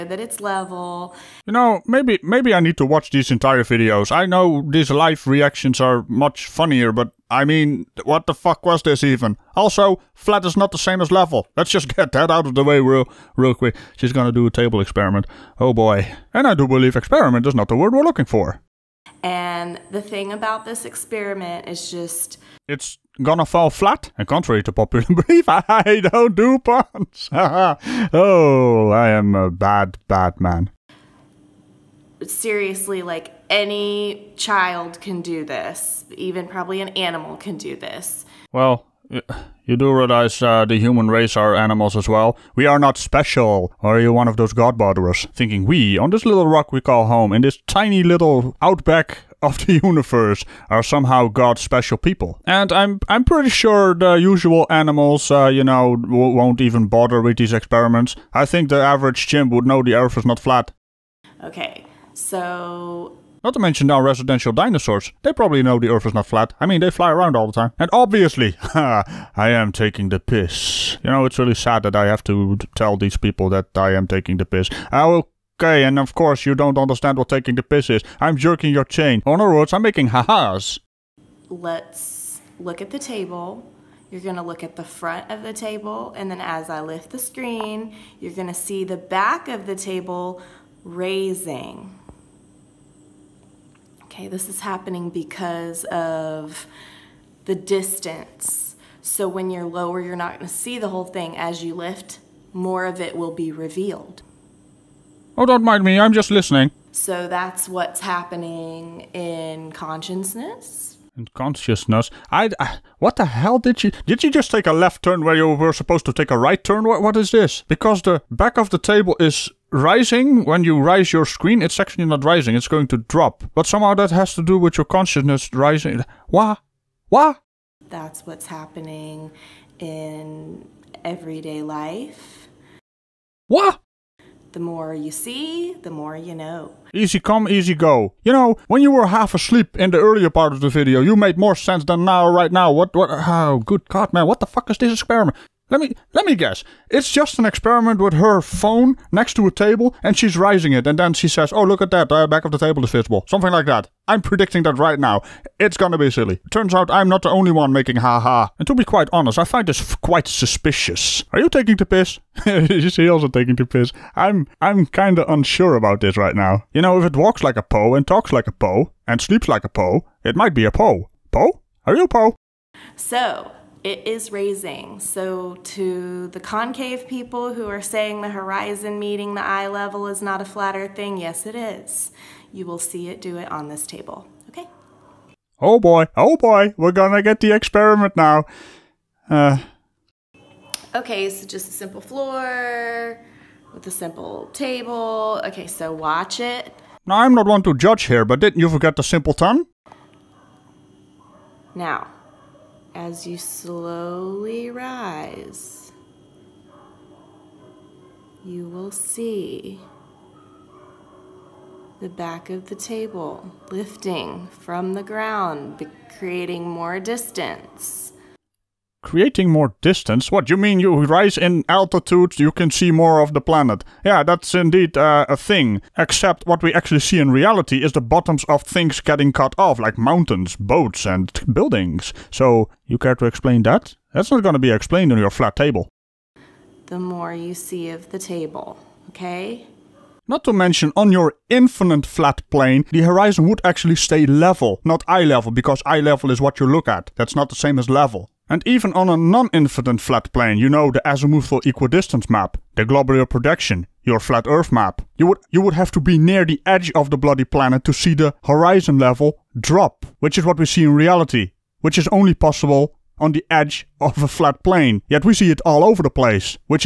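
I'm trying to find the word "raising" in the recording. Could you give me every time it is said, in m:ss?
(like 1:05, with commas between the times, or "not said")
1:30, 2:30, 2:54.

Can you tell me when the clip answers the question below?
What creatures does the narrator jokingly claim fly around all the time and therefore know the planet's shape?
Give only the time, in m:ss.
1:04.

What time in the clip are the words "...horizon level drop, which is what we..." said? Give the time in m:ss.
4:18.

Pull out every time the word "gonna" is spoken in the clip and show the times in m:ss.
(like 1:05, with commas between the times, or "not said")
0:14, 0:23, 1:24, 1:28, 1:40, 2:35, 3:06, 3:54.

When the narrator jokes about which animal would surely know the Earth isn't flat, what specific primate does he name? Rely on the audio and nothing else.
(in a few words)
chimp.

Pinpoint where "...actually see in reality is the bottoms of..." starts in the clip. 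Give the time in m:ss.
3:46.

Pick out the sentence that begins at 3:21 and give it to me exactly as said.
Now, as you slowly rise, you will see the back of the table lifting from the ground, creating more distance.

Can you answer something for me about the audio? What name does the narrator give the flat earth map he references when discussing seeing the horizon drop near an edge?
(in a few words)
azimuthal equidistance map.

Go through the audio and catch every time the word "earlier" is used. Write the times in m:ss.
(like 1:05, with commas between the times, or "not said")
2:19.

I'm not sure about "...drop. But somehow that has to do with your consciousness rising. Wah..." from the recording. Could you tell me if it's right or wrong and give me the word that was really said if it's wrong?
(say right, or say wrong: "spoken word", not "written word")
right.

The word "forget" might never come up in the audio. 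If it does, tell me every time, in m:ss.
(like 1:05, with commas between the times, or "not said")
3:18.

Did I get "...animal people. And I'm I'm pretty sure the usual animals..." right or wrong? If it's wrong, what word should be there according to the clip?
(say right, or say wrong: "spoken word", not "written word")
wrong: "special", not "animal".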